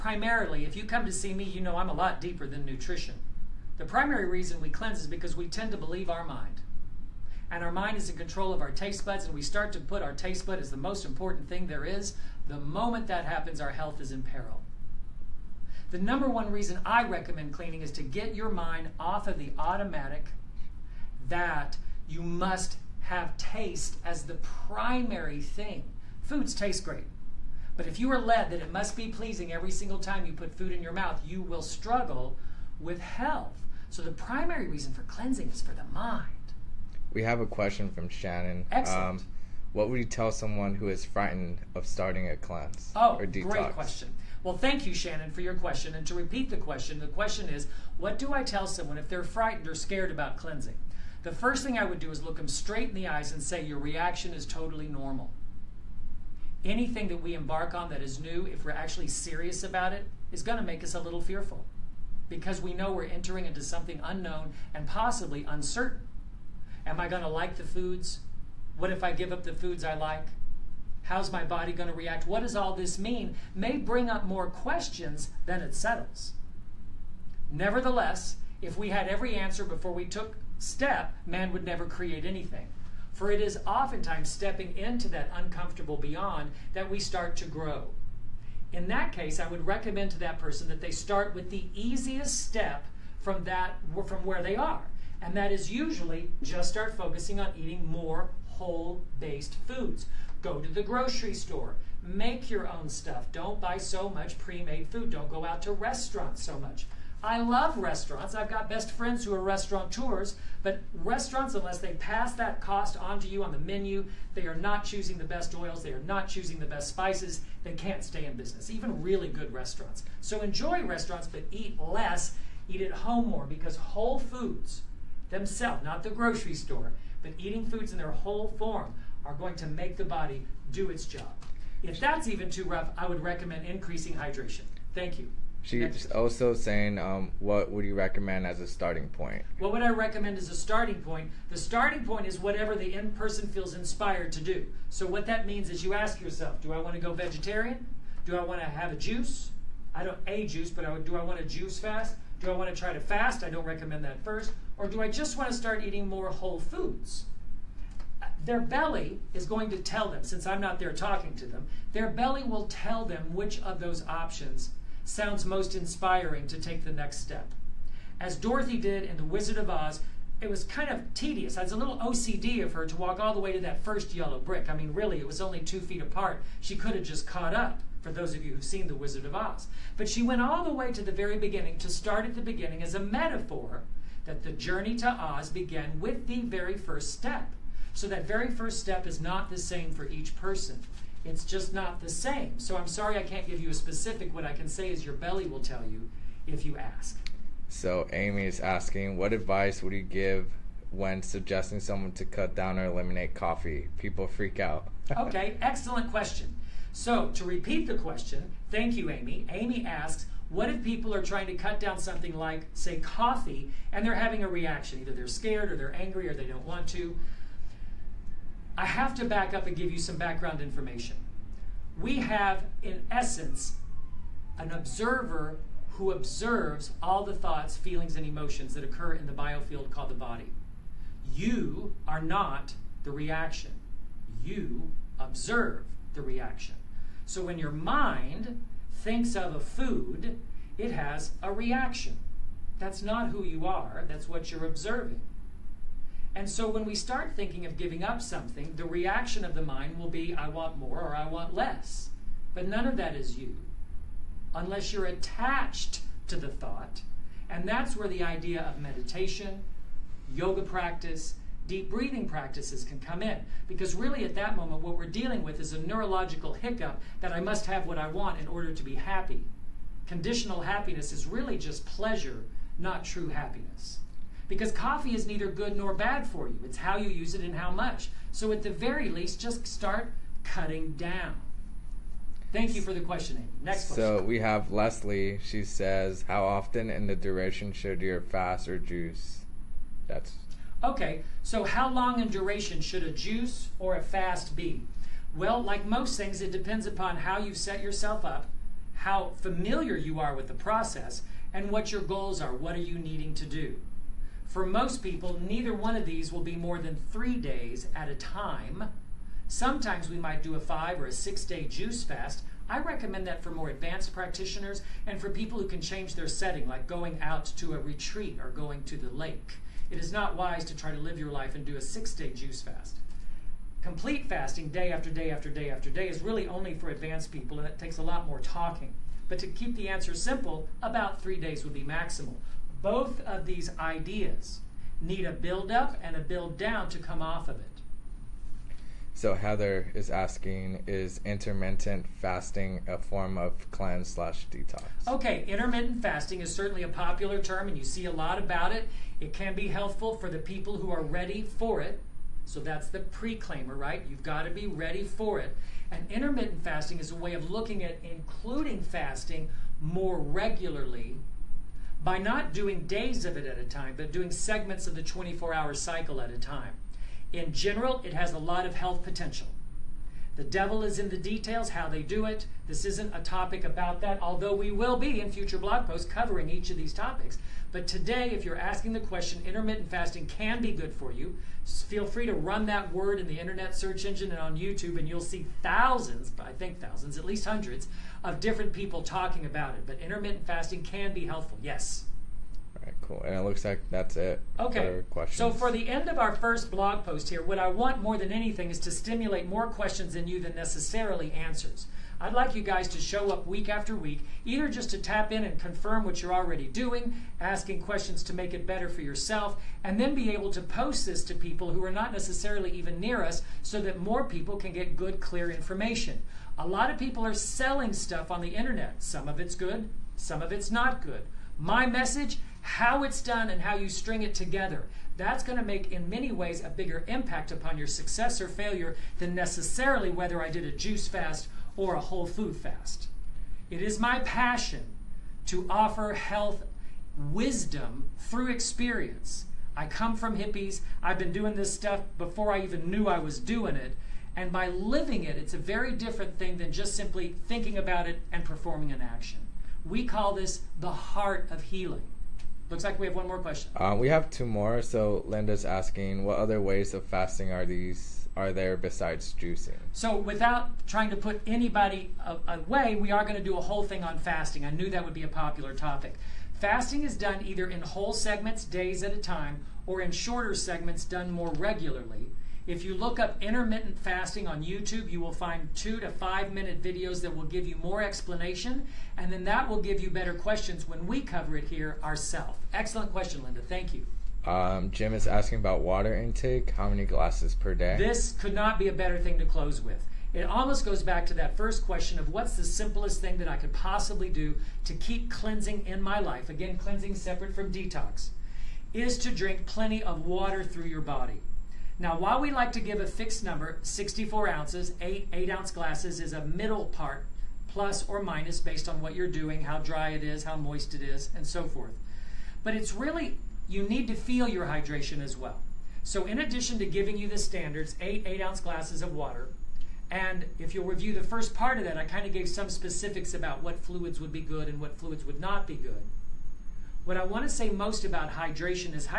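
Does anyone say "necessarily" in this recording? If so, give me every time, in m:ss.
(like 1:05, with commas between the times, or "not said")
6:40, 6:52, 7:09.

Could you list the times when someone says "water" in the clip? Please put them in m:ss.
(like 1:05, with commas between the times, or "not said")
8:05, 8:20, 8:39.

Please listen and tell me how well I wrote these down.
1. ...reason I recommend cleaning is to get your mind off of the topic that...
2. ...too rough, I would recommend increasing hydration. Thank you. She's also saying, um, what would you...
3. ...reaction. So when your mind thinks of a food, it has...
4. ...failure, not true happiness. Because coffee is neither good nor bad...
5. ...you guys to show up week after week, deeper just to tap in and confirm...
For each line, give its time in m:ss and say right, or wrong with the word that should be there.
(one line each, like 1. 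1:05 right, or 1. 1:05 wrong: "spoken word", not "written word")
1. 0:16 wrong: "automatic", not "topic"
2. 2:12 right
3. 3:56 right
4. 4:31 wrong: "pleasure", not "failure"
5. 6:42 wrong: "either", not "deeper".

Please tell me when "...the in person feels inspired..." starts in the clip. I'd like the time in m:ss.
2:22.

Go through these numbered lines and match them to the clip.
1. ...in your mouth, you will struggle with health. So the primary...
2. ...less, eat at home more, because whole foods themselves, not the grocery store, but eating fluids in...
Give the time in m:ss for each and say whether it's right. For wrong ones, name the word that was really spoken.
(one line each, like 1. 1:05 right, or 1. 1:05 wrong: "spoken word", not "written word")
1. 0:30 right
2. 2:01 wrong: "foods", not "fluids".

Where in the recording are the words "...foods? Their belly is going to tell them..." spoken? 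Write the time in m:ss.
2:36.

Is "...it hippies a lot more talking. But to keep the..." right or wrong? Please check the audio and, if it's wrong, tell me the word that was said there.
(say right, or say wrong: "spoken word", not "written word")
wrong: "takes", not "hippies".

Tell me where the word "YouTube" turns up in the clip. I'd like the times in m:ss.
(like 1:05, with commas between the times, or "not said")
6:24, 7:54.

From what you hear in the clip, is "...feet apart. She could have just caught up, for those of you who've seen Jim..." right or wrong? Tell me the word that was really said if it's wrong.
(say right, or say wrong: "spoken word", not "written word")
wrong: "The", not "Jim".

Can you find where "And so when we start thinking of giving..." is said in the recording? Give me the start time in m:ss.
4:06.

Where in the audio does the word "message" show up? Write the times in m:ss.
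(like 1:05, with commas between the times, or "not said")
7:01.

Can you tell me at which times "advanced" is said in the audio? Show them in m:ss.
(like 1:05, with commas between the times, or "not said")
5:13, 5:26.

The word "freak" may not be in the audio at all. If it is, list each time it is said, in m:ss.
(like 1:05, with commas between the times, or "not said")
3:24.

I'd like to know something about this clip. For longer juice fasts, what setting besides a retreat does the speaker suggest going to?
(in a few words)
the lake.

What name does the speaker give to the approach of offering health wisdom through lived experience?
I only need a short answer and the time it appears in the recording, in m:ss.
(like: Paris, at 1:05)
the heart of healing, at 7:30.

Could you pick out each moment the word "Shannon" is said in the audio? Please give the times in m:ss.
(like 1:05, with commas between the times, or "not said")
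0:38, 0:44.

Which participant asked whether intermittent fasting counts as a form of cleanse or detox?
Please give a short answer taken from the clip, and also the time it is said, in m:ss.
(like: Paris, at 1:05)
Heather, at 5:39.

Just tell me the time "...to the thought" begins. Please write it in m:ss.
4:16.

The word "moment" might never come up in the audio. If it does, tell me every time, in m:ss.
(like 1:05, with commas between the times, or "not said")
0:12, 4:24.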